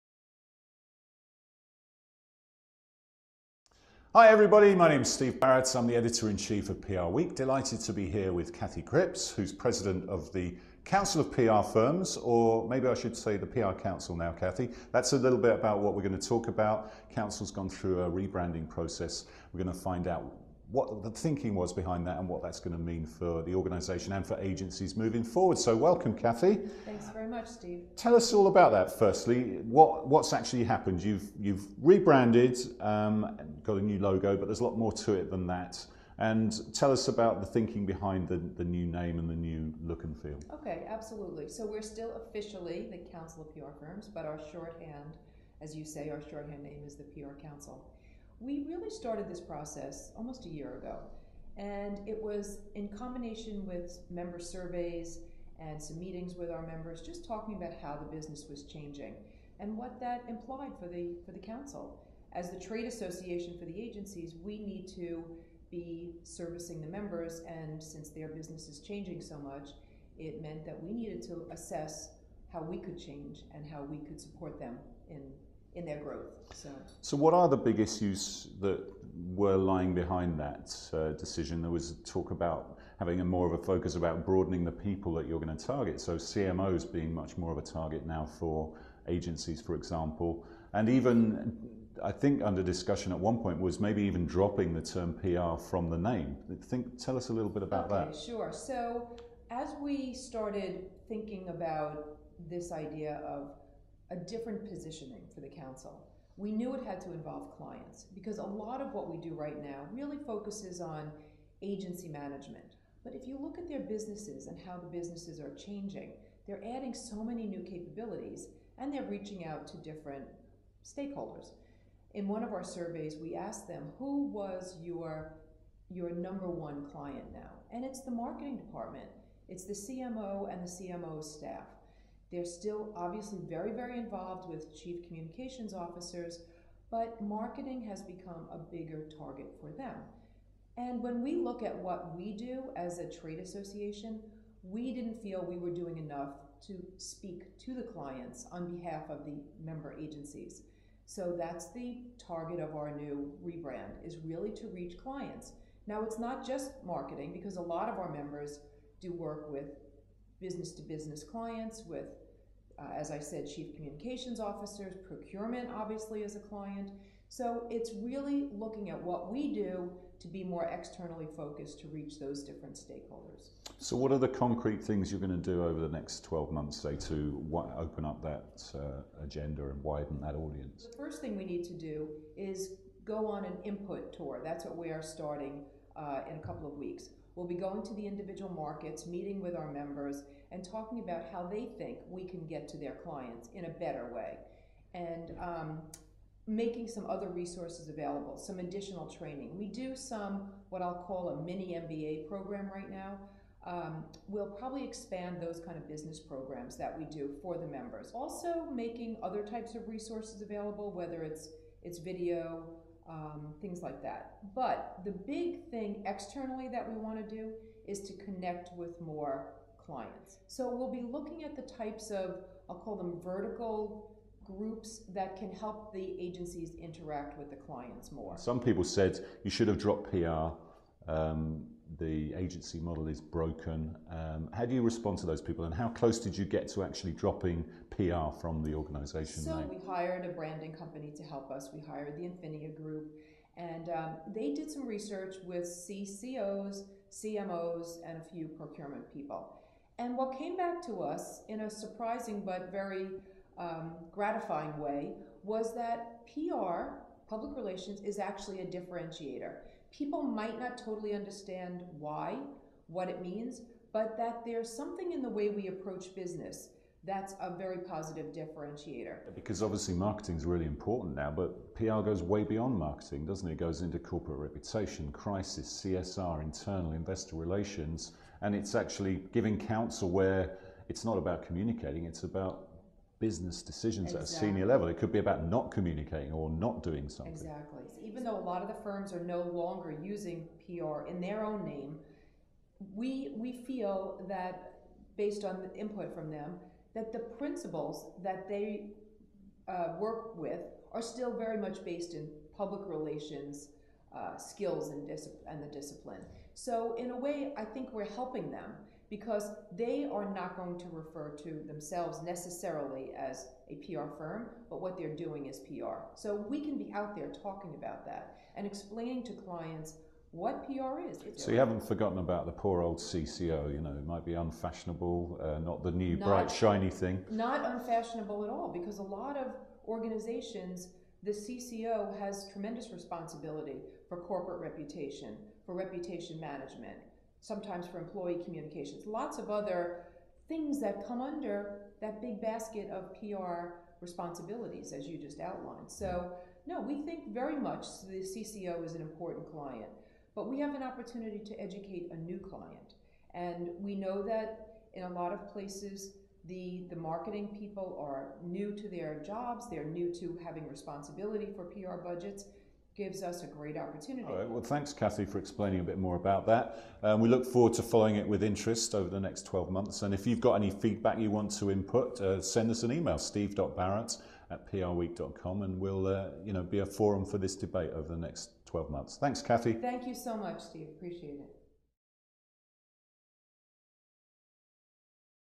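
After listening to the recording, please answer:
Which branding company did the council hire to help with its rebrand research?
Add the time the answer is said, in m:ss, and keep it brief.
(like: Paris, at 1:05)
Infinia Group, at 4:02.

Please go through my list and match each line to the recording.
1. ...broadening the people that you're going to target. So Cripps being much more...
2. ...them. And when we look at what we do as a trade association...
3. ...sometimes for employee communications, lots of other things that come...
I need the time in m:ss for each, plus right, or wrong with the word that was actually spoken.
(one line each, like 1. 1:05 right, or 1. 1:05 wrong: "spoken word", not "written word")
1. 1:24 wrong: "CMOs", not "Cripps"
2. 2:19 right
3. 5:37 right.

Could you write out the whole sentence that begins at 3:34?
But the big thing externally that we want to do is to connect with more clients.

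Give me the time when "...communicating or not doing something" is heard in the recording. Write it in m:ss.
4:45.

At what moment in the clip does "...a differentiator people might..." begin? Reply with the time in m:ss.
4:18.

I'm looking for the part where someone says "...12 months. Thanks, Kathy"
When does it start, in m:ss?
6:18.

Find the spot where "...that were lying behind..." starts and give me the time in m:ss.
1:18.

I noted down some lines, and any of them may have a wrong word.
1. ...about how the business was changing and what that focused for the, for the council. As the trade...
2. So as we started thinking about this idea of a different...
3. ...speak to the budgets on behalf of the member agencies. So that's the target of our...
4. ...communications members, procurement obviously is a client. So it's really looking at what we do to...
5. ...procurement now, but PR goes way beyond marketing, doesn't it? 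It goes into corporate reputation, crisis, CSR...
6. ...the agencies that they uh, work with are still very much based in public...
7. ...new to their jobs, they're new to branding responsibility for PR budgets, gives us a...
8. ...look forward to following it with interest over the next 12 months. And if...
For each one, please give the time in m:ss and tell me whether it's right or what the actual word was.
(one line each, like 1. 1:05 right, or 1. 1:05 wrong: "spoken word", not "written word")
1. 0:57 wrong: "implied", not "focused"
2. 1:38 right
3. 2:26 wrong: "clients", not "budgets"
4. 2:43 wrong: "officers", not "members"
5. 4:30 wrong: "important", not "procurement"
6. 4:57 wrong: "principles", not "agencies"
7. 5:58 wrong: "having", not "branding"
8. 6:07 right.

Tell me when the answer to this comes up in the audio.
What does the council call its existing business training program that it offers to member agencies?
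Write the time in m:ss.
3:21.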